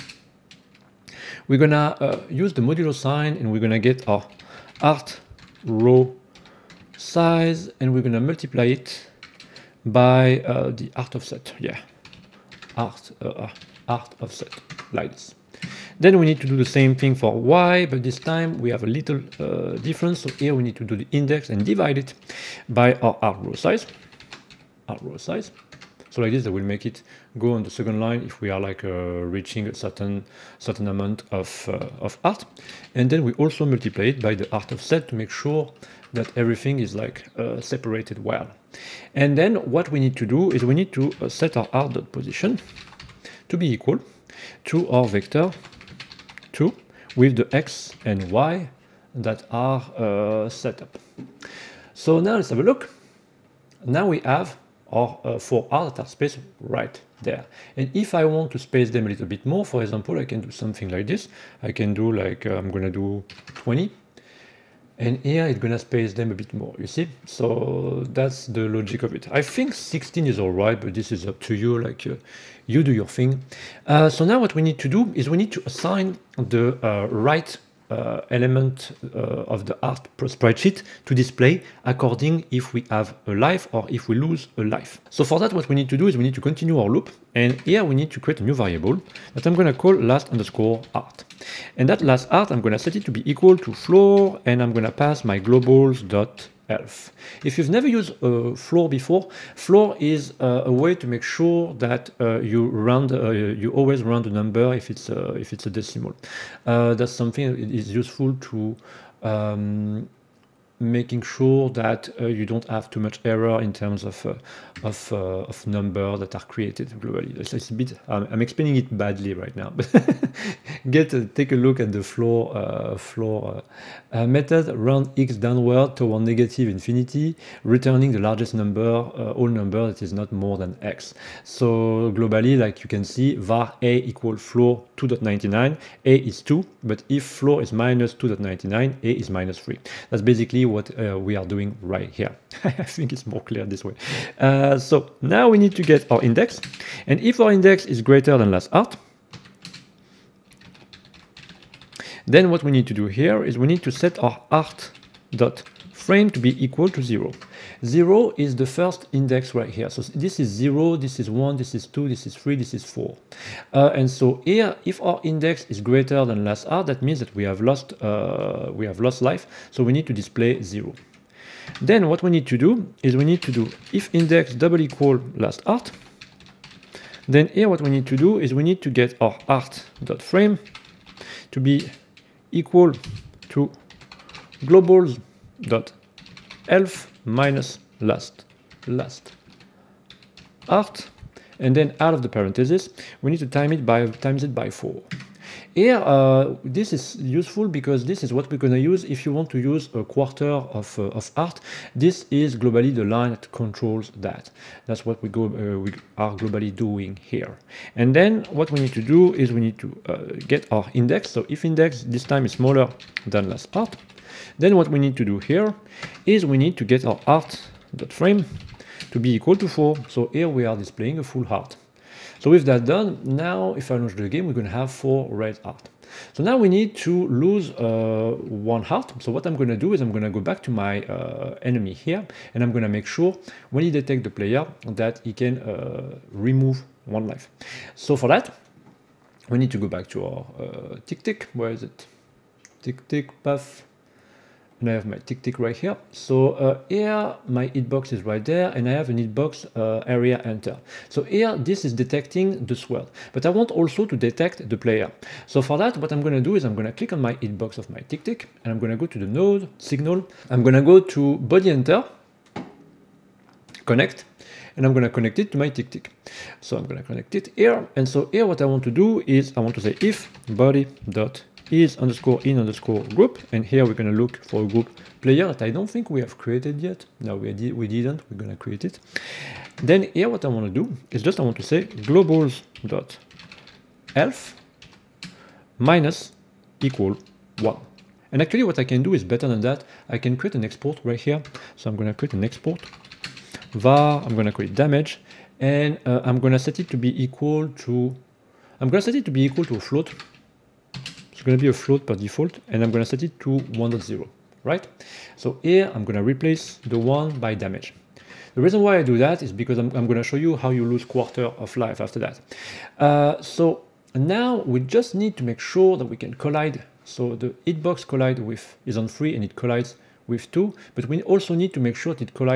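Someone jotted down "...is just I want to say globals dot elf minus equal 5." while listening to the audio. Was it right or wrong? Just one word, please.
wrong.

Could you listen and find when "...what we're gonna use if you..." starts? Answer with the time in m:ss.
3:18.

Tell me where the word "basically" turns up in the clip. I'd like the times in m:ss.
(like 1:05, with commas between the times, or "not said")
2:20.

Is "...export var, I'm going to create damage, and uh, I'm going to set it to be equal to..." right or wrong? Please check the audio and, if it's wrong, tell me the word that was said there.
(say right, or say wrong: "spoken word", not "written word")
right.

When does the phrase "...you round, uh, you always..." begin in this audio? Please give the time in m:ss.
1:42.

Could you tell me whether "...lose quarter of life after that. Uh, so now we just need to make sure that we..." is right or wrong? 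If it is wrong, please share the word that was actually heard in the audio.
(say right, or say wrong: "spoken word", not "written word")
right.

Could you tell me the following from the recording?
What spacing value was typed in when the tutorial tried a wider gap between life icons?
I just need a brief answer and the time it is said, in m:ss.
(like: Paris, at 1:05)
20, at 1:03.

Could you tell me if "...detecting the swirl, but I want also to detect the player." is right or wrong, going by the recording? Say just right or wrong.
right.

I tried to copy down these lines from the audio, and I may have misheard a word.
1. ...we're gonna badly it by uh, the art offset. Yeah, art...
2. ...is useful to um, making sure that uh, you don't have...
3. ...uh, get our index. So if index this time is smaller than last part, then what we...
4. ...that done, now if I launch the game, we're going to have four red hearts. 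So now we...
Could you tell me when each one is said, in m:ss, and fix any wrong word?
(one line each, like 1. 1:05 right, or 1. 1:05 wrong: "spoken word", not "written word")
1. 0:07 wrong: "multiply", not "badly"
2. 1:47 right
3. 3:30 right
4. 3:42 right.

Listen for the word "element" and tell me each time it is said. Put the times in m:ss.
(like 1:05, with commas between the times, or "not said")
1:18.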